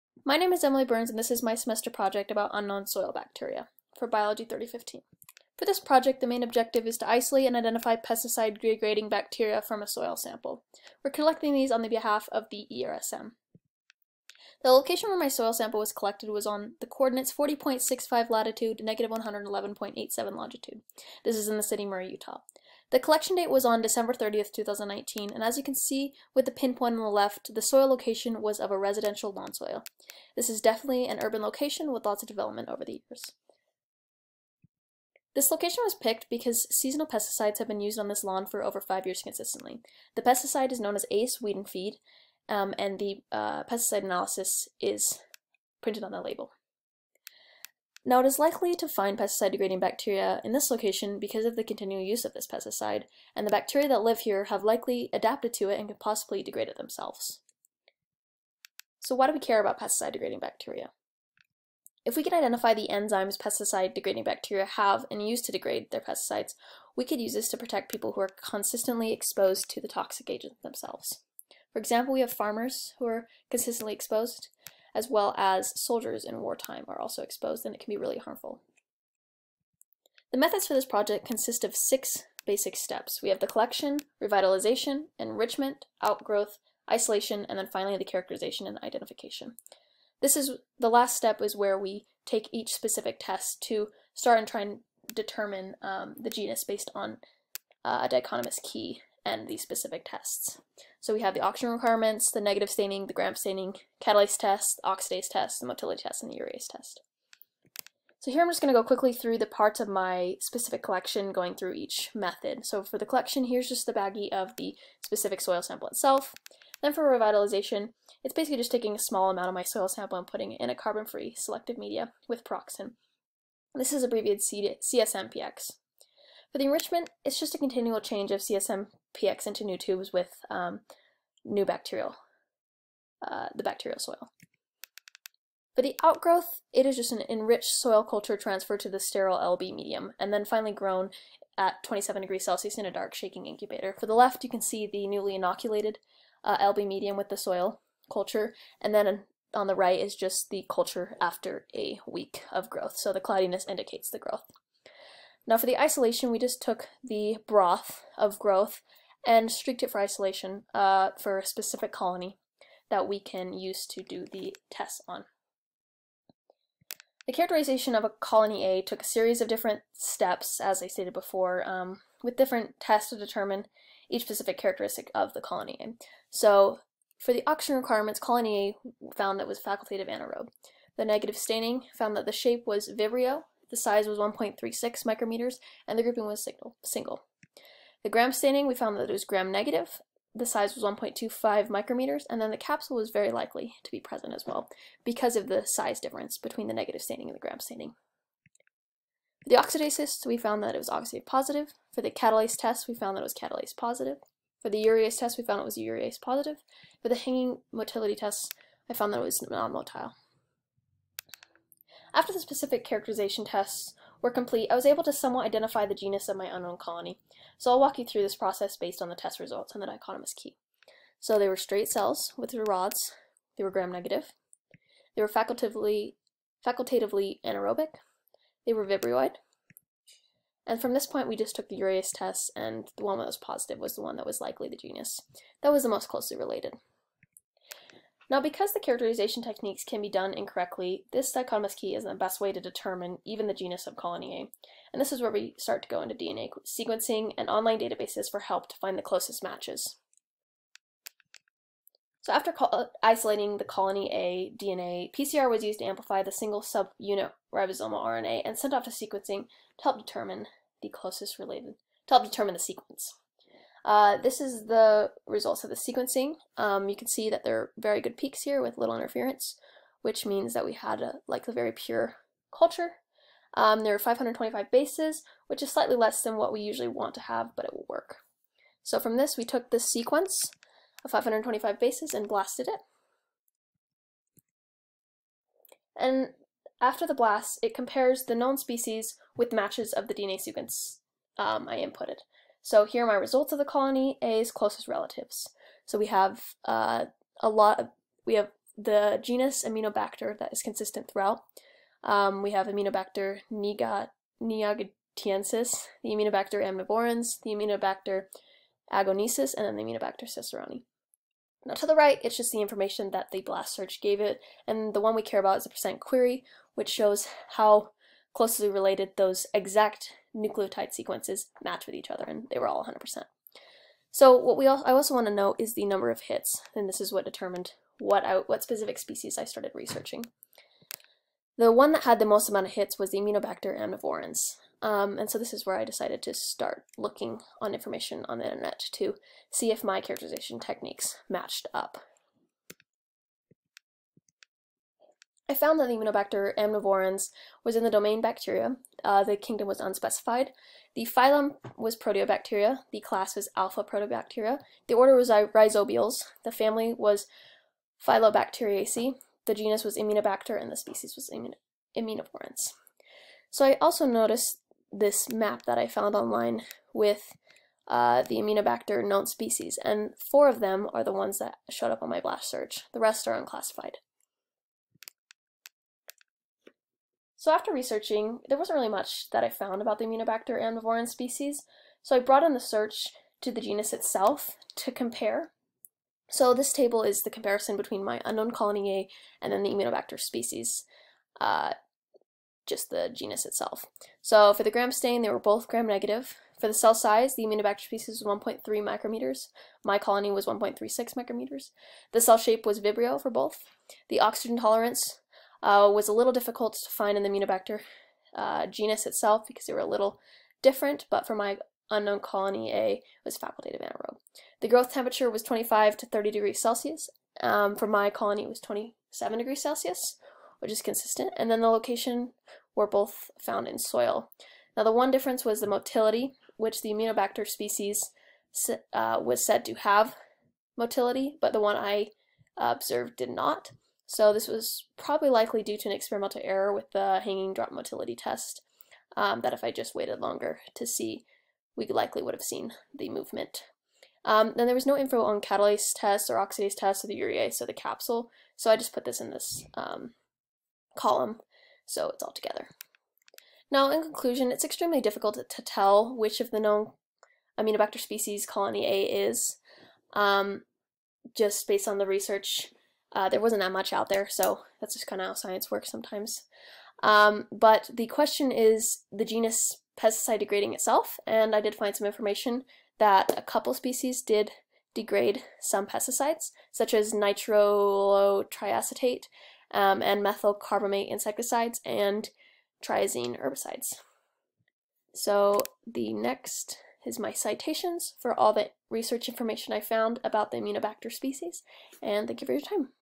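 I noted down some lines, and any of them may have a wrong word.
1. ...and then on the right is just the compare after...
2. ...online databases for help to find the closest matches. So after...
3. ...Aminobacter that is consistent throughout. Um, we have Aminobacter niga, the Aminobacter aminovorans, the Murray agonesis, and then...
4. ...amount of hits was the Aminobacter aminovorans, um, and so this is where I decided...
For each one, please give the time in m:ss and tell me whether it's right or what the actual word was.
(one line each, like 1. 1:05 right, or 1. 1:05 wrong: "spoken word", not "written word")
1. 2:28 wrong: "culture", not "compare"
2. 4:07 right
3. 4:59 wrong: "Aminobacter", not "Murray"
4. 5:32 right.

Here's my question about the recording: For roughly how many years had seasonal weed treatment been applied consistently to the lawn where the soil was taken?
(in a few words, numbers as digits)
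5 years.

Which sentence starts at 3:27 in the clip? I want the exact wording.
For the hanging motility test, I found that it was non-motile.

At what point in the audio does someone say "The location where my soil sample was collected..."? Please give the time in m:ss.
0:14.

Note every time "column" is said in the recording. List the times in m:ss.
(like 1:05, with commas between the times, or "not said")
7:30.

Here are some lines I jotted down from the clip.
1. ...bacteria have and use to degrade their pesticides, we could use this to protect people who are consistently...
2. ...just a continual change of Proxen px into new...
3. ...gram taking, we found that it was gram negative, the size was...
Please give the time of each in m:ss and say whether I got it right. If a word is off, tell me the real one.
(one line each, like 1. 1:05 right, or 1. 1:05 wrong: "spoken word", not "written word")
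1. 1:04 right
2. 2:07 wrong: "CSM", not "Proxen"
3. 3:08 wrong: "staining", not "taking".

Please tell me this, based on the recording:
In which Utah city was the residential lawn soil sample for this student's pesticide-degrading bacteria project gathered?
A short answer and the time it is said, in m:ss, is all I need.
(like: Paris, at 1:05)
Murray, at 0:21.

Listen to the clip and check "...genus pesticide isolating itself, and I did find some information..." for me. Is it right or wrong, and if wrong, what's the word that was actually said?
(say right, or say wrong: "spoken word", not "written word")
wrong: "degrading", not "isolating".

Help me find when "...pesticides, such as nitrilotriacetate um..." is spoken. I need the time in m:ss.
7:55.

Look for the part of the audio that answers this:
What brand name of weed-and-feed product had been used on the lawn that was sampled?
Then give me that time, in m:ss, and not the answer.
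0:41.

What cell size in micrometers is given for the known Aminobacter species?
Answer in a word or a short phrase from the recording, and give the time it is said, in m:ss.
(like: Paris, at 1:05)
1.3 micrometers, at 6:38.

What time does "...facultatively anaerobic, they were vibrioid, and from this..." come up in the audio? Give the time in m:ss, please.
3:46.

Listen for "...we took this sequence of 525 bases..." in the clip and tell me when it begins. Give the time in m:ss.
4:39.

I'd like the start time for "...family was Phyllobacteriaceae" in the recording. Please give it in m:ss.
5:56.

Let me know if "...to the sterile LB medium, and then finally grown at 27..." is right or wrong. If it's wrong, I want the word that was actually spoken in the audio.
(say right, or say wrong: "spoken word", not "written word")
right.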